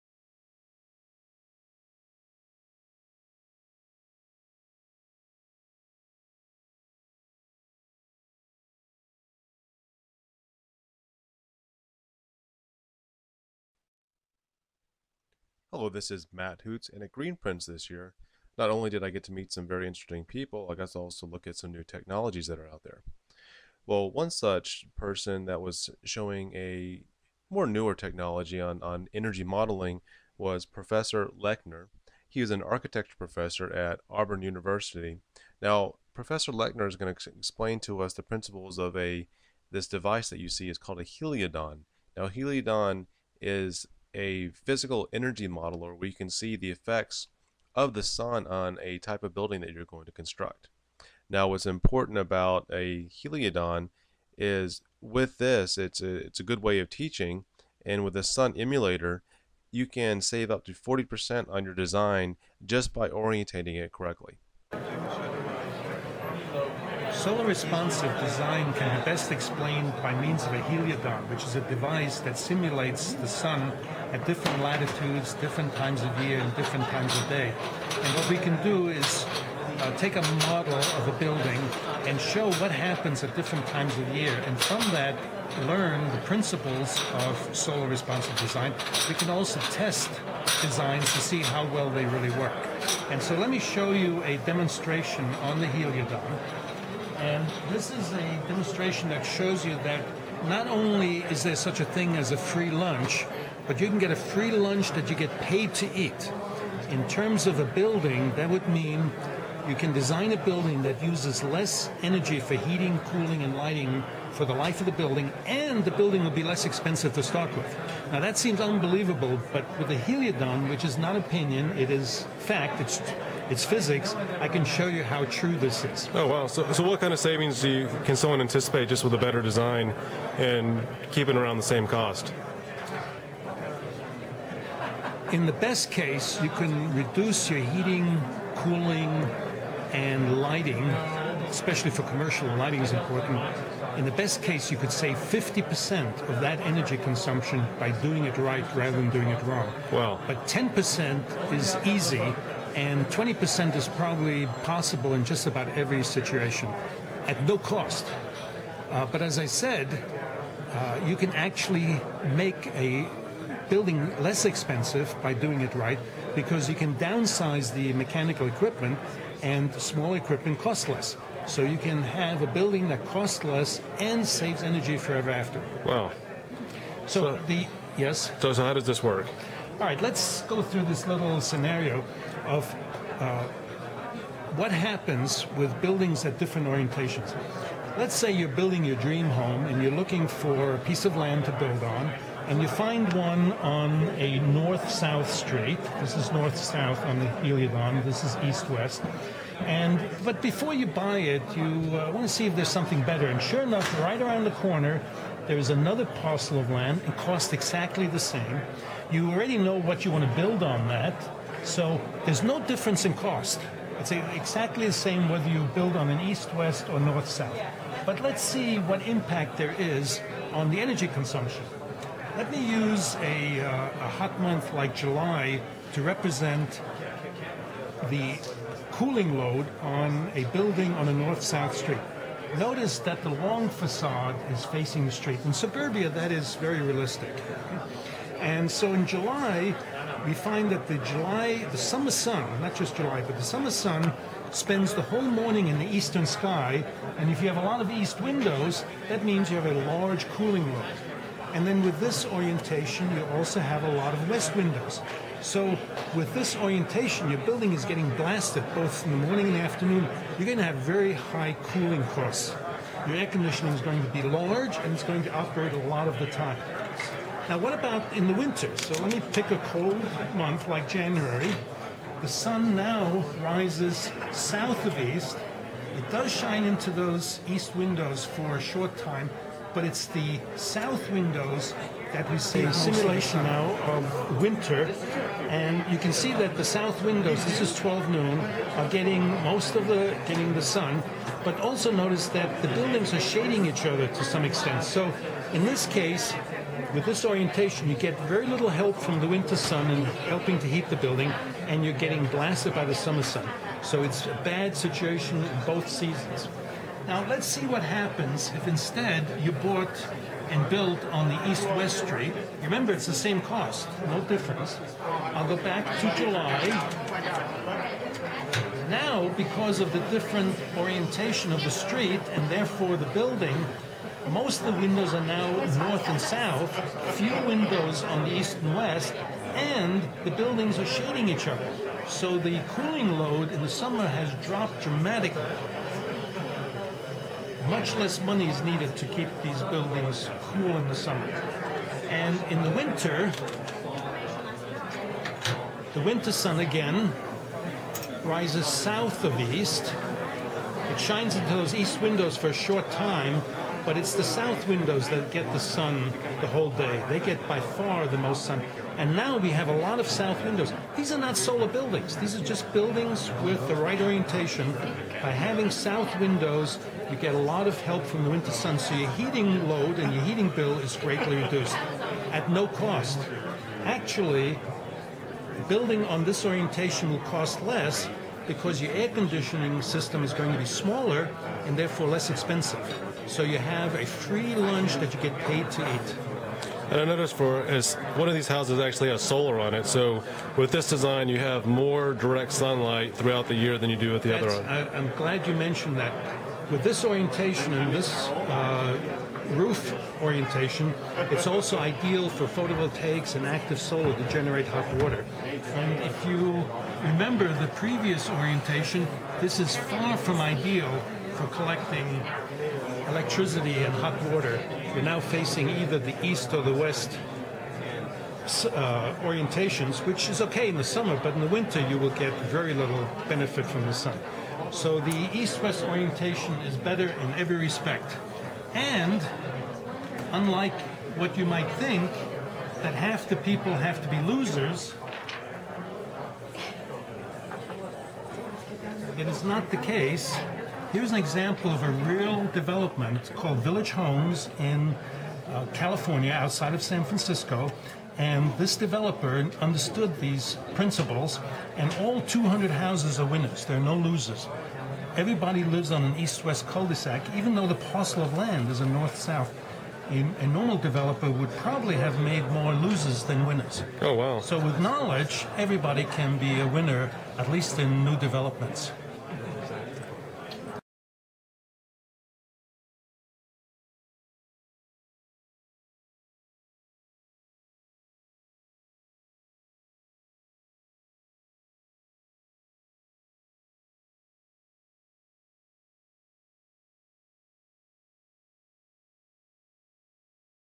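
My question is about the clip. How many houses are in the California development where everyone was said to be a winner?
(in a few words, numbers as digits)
200.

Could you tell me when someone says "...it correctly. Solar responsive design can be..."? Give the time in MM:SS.
01:03.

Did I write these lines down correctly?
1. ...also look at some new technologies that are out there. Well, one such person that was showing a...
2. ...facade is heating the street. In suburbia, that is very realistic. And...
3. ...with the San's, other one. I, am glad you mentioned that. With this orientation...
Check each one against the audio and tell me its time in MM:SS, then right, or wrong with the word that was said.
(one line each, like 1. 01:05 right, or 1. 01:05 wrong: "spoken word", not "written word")
1. 00:20 right
2. 03:53 wrong: "facing", not "heating"
3. 06:34 wrong: "That", not "San".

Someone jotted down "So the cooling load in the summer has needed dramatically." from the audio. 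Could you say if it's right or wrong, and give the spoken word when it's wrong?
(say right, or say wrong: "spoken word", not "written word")
wrong: "dropped", not "needed".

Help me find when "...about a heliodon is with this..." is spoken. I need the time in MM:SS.
00:52.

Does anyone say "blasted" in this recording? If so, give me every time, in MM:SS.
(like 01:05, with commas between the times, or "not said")
04:18, 05:02.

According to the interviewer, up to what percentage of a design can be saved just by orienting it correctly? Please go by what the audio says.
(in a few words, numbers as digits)
40%.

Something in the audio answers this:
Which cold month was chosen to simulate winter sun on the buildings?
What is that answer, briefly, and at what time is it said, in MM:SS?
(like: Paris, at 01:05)
January, at 04:30.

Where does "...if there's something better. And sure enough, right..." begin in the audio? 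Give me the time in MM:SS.
03:22.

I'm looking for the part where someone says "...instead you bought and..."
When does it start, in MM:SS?
05:08.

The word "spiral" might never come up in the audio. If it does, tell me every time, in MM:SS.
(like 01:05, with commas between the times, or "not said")
not said.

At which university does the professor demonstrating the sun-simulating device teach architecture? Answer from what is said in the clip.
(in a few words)
Auburn University.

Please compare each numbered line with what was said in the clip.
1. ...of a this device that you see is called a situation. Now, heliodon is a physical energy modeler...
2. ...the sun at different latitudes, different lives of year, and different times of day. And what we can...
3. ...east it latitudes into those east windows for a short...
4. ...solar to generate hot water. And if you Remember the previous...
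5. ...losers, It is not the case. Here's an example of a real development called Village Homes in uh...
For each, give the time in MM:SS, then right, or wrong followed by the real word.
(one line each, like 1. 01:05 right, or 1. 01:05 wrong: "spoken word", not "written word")
1. 00:38 wrong: "heliodon", not "situation"
2. 01:13 wrong: "times", not "lives"
3. 05:49 wrong: "shines", not "latitudes"
4. 06:43 right
5. 07:14 right.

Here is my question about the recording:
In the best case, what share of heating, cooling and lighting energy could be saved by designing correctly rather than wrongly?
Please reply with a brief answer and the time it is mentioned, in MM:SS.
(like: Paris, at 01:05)
50%, at 02:25.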